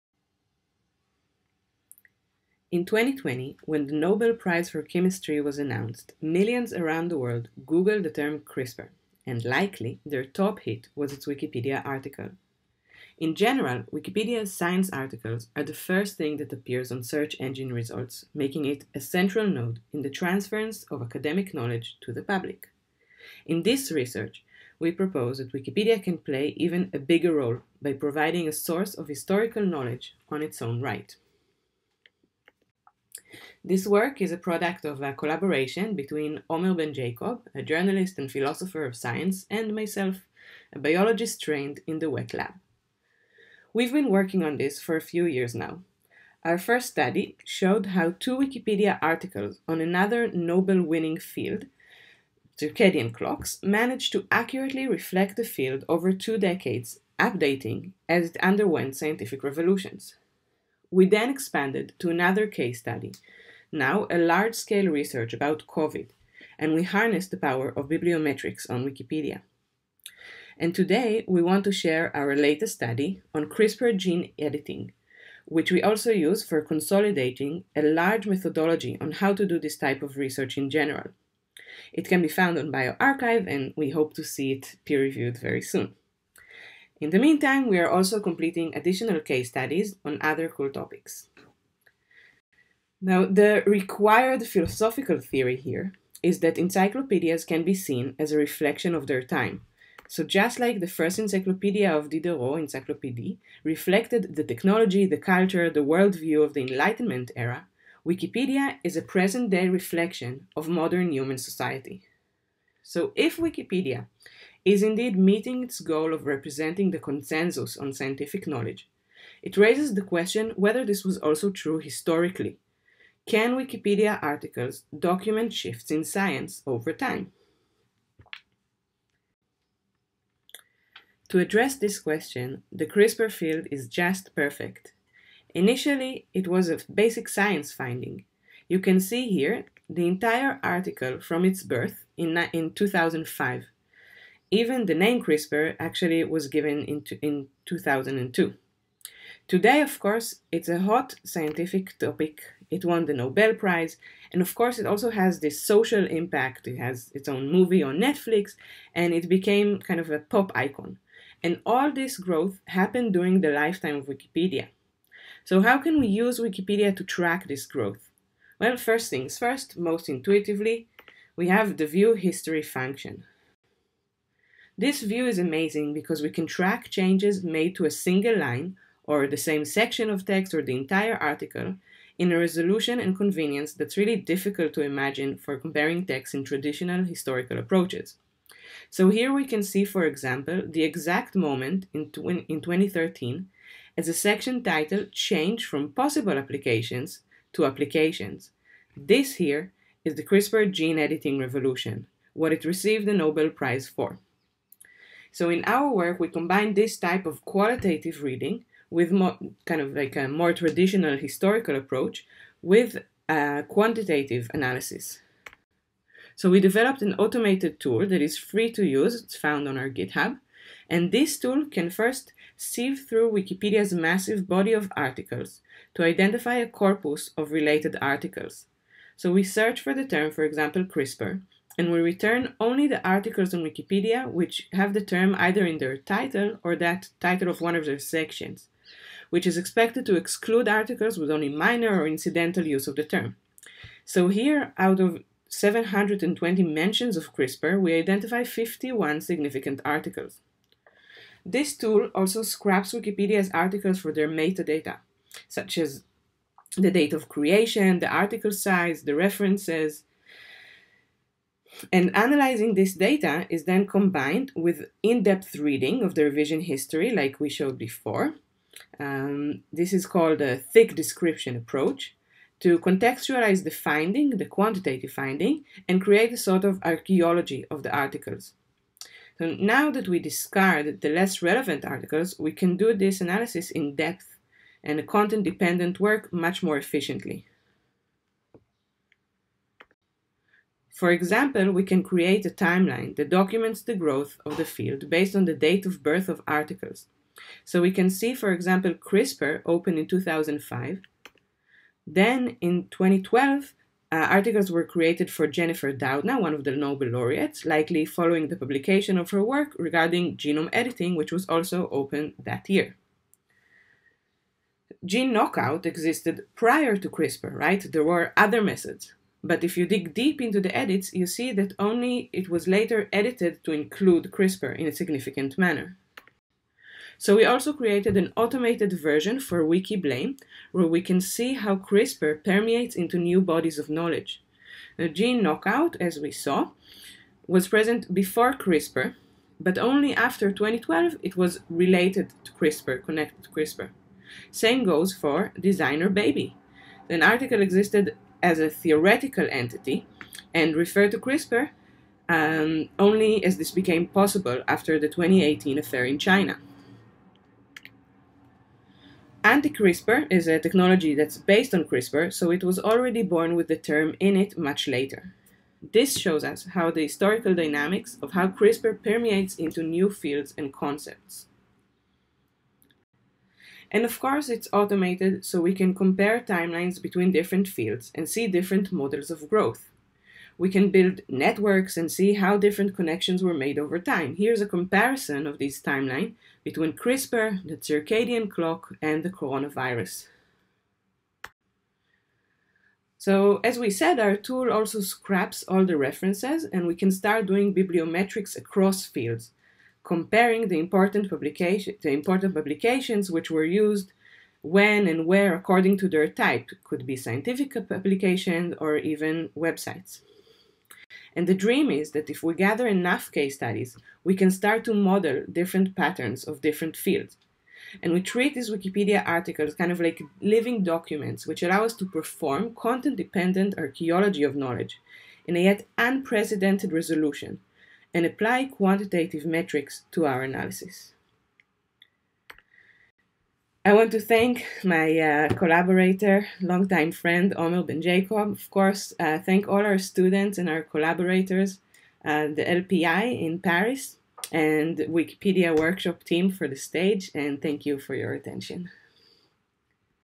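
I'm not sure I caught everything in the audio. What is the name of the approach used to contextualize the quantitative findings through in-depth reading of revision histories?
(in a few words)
thick description.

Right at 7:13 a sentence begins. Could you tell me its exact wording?
I want to thank my uh, collaborator, longtime friend Omer Benjakob.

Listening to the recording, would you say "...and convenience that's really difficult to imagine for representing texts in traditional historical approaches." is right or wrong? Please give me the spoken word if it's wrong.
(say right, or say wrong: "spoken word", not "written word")
wrong: "comparing", not "representing".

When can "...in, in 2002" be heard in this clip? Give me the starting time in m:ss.
2:26.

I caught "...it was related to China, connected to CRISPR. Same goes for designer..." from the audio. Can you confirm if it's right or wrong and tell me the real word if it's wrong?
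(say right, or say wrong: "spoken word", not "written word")
wrong: "CRISPR", not "China".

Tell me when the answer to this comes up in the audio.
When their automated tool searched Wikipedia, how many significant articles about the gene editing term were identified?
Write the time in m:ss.
4:08.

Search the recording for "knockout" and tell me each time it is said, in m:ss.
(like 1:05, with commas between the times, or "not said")
5:15, 5:35.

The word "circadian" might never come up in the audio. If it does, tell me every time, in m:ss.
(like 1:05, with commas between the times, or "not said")
0:52, 6:27.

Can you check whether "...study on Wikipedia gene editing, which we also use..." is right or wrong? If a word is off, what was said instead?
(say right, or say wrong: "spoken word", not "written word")
wrong: "CRISPR", not "Wikipedia".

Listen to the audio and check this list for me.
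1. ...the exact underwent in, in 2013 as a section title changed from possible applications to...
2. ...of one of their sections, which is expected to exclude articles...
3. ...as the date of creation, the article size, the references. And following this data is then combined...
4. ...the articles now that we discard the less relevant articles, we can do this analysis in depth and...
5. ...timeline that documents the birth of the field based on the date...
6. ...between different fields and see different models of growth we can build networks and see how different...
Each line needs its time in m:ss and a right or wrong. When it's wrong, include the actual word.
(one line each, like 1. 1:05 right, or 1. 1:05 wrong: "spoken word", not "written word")
1. 3:10 wrong: "moment", not "underwent"
2. 3:57 right
3. 4:15 wrong: "analyzing", not "following"
4. 4:37 right
5. 4:52 wrong: "growth", not "birth"
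6. 6:17 right.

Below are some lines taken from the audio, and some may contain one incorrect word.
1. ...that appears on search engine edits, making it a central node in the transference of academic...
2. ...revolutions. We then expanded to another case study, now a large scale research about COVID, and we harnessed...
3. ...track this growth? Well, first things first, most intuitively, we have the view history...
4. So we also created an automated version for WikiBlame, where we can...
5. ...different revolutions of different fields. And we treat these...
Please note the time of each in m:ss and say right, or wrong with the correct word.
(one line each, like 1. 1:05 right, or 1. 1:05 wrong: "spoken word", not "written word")
1. 0:16 wrong: "results", not "edits"
2. 0:59 right
3. 2:47 right
4. 5:27 right
5. 6:55 wrong: "patterns", not "revolutions".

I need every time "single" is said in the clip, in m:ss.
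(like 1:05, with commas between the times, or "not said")
2:58.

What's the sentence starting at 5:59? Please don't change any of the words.
Anti-CRISPR is a technology that's based on CRISPR, so it was already born with the term in it much later.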